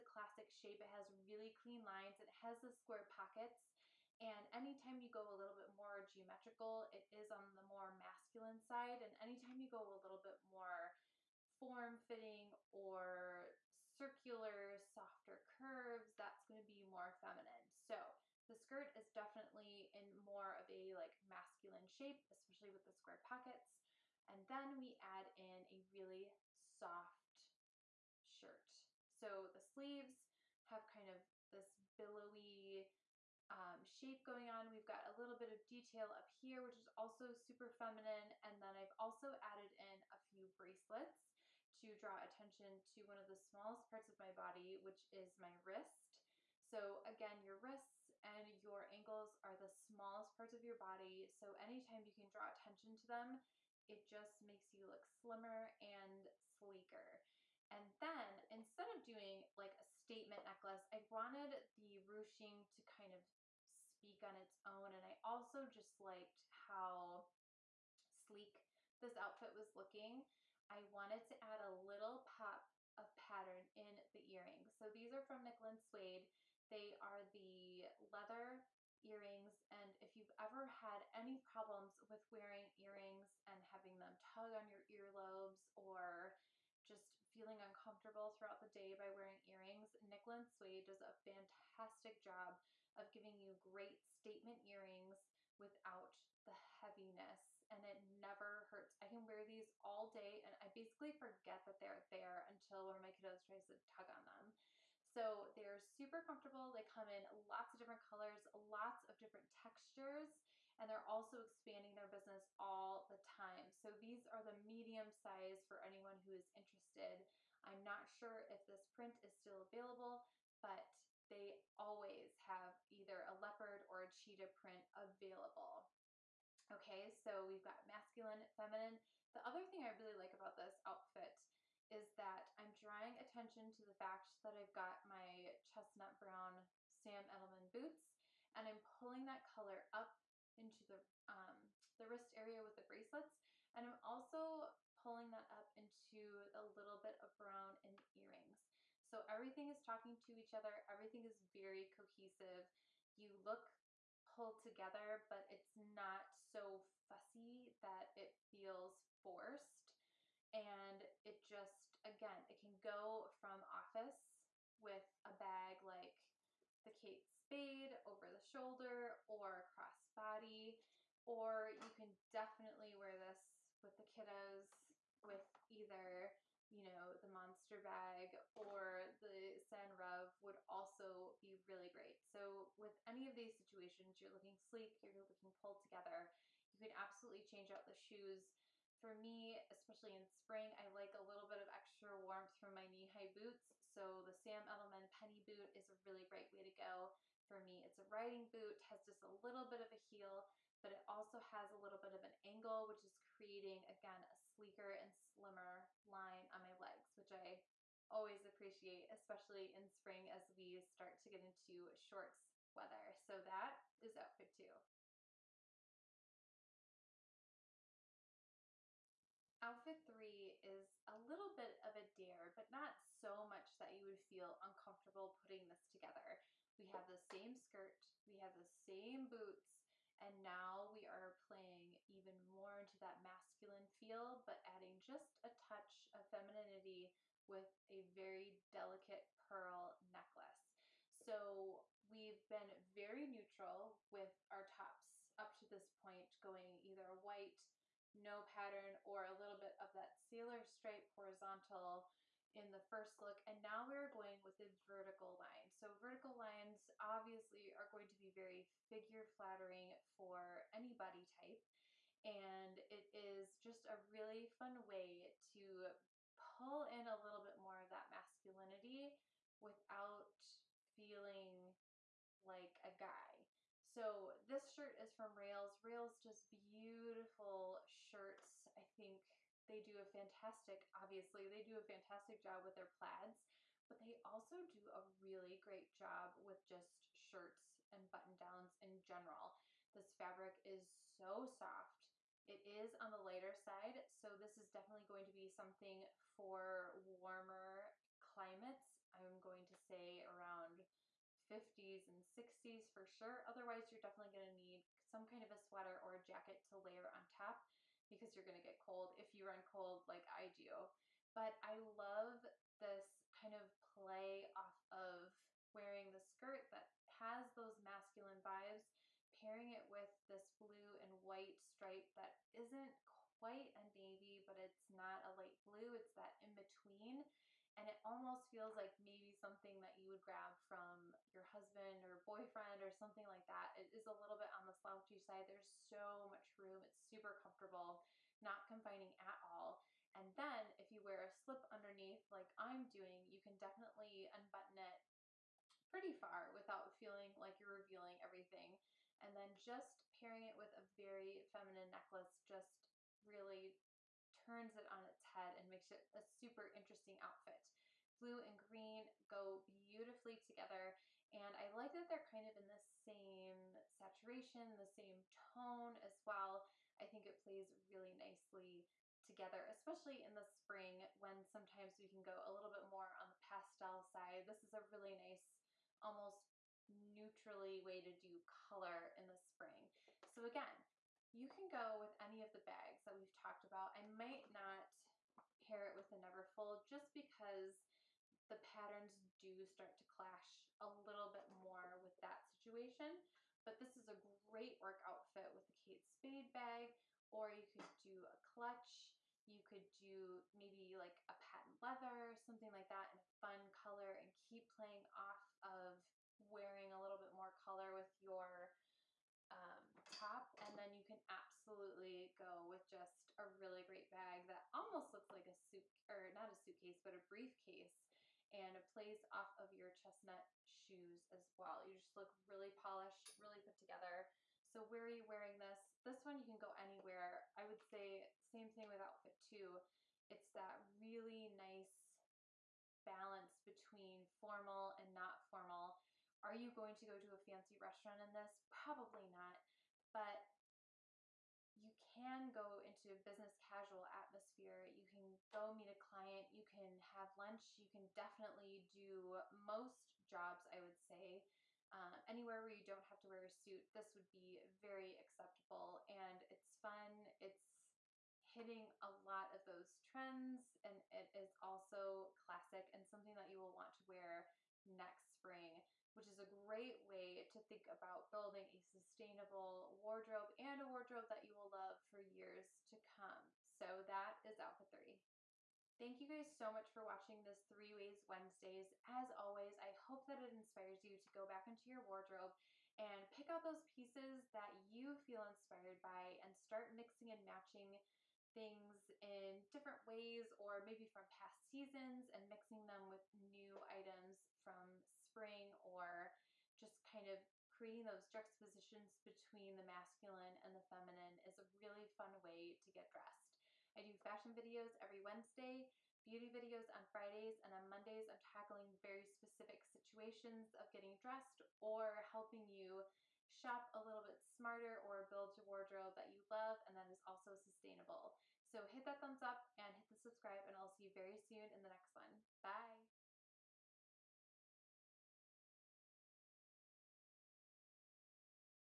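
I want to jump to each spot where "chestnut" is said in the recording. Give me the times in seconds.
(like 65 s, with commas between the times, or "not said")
135 s, 419 s.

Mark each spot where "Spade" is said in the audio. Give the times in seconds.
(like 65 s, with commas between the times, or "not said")
167 s, 396 s.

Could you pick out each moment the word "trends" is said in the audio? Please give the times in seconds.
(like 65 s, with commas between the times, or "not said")
460 s.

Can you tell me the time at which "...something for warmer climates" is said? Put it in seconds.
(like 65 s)
295 s.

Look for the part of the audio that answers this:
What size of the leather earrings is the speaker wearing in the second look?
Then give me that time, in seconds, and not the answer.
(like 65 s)
114 s.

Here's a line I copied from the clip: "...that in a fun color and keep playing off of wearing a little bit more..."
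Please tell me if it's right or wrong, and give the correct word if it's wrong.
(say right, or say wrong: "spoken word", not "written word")
right.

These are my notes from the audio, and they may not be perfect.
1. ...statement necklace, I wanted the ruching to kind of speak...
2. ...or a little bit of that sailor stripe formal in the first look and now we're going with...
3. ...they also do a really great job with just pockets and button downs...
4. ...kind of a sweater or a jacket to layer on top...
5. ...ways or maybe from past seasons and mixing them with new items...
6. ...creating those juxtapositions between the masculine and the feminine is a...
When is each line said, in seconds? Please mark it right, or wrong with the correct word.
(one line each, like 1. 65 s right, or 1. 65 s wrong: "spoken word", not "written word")
1. 59 s right
2. 249 s wrong: "horizontal", not "formal"
3. 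283 s wrong: "shirts", not "pockets"
4. 305 s right
5. 490 s right
6. 497 s right.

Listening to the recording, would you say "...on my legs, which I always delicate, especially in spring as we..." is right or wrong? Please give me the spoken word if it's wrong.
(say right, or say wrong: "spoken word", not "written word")
wrong: "appreciate", not "delicate".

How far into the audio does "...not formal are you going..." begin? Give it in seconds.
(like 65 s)
435 s.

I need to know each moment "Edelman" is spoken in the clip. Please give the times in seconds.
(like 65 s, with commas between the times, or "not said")
137 s, 194 s.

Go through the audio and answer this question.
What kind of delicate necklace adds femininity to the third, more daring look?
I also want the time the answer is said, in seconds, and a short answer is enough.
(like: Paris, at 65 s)
Pearl necklace, at 239 s.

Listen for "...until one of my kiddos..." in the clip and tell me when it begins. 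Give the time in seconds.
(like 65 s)
102 s.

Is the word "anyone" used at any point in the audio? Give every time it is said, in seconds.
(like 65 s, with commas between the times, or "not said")
115 s.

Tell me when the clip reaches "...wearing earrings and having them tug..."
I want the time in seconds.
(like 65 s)
82 s.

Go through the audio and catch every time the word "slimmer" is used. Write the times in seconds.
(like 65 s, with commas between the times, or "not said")
55 s, 205 s.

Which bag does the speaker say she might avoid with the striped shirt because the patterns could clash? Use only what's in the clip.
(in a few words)
Neverfull.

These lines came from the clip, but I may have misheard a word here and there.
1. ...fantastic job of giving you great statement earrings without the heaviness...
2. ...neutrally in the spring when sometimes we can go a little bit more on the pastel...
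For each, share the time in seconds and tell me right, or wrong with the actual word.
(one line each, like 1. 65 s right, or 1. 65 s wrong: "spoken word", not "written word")
1. 91 s right
2. 369 s wrong: "especially", not "neutrally".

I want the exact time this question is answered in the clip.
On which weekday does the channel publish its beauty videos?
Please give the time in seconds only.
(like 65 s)
507 s.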